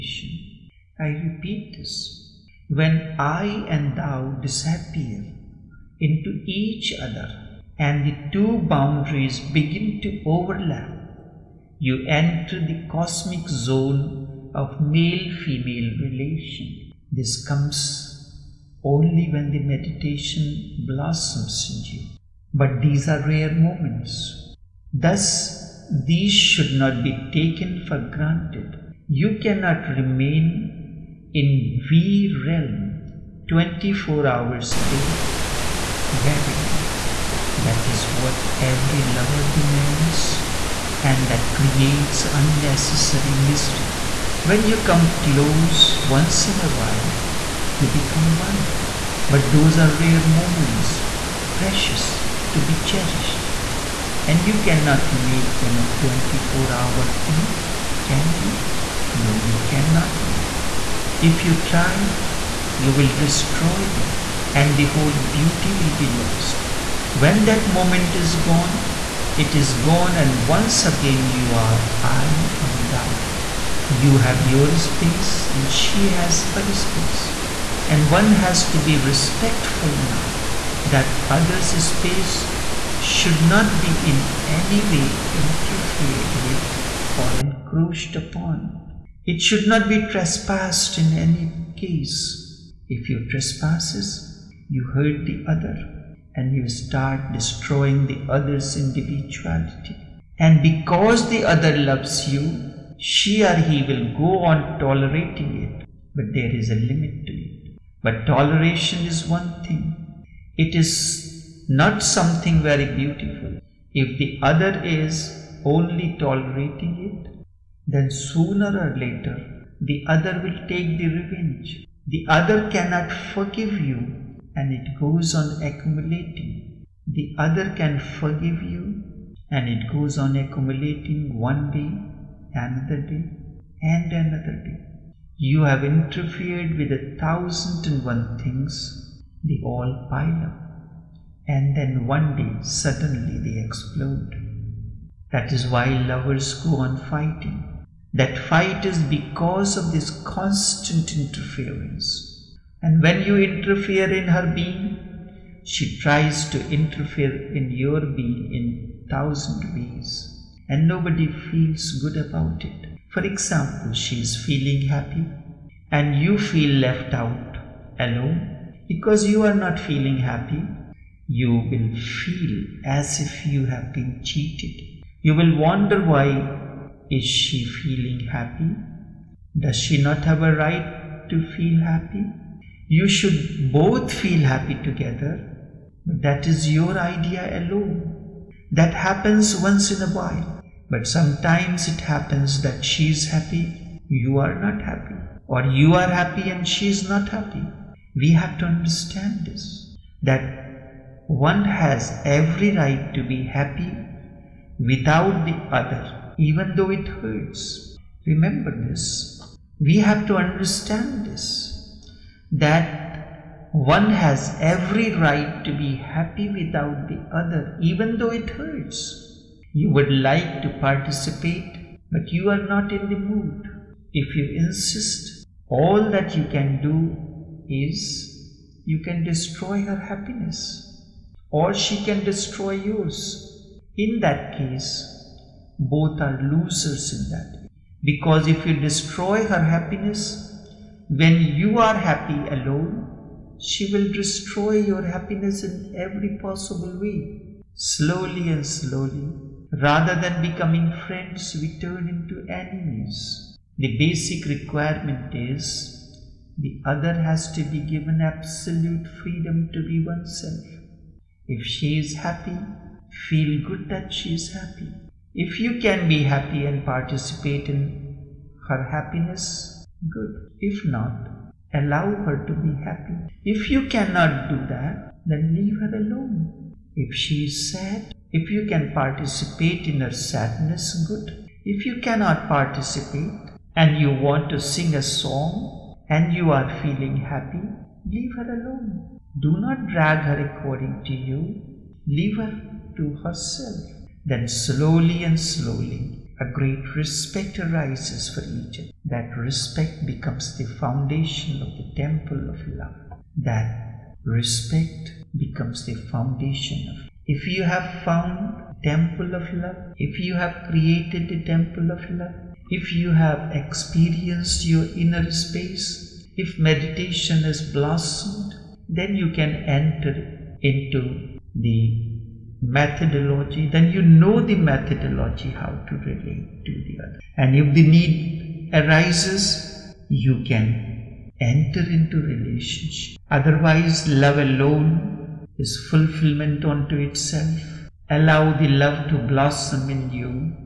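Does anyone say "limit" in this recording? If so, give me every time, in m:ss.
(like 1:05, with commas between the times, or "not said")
1:46.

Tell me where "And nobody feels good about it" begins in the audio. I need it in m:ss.
2:40.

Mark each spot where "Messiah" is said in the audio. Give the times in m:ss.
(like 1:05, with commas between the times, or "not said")
not said.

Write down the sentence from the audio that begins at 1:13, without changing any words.
You have your space and she has her space.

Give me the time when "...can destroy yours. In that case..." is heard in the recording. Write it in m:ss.
3:52.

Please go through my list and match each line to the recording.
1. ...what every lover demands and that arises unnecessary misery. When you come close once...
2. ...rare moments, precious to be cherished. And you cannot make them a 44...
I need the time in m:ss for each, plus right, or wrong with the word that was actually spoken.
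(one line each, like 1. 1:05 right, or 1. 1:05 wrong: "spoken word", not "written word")
1. 0:38 wrong: "creates", not "arises"
2. 0:49 wrong: "24", not "44".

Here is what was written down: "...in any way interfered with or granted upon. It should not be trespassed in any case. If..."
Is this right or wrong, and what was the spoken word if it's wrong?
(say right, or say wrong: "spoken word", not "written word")
wrong: "encroached", not "granted".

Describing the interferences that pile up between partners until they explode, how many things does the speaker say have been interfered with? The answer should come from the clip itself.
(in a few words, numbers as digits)
1001.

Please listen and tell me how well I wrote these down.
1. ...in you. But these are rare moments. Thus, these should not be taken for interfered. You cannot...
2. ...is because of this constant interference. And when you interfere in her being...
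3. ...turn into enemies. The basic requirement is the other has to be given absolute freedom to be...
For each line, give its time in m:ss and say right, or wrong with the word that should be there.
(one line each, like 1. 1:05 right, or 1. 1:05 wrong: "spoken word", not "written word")
1. 0:21 wrong: "granted", not "interfered"
2. 2:28 right
3. 4:11 right.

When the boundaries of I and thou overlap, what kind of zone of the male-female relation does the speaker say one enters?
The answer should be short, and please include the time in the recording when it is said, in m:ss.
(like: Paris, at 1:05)
cosmic zone, at 0:12.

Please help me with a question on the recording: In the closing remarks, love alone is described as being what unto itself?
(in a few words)
fulfillment.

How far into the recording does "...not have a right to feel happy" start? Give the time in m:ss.
3:00.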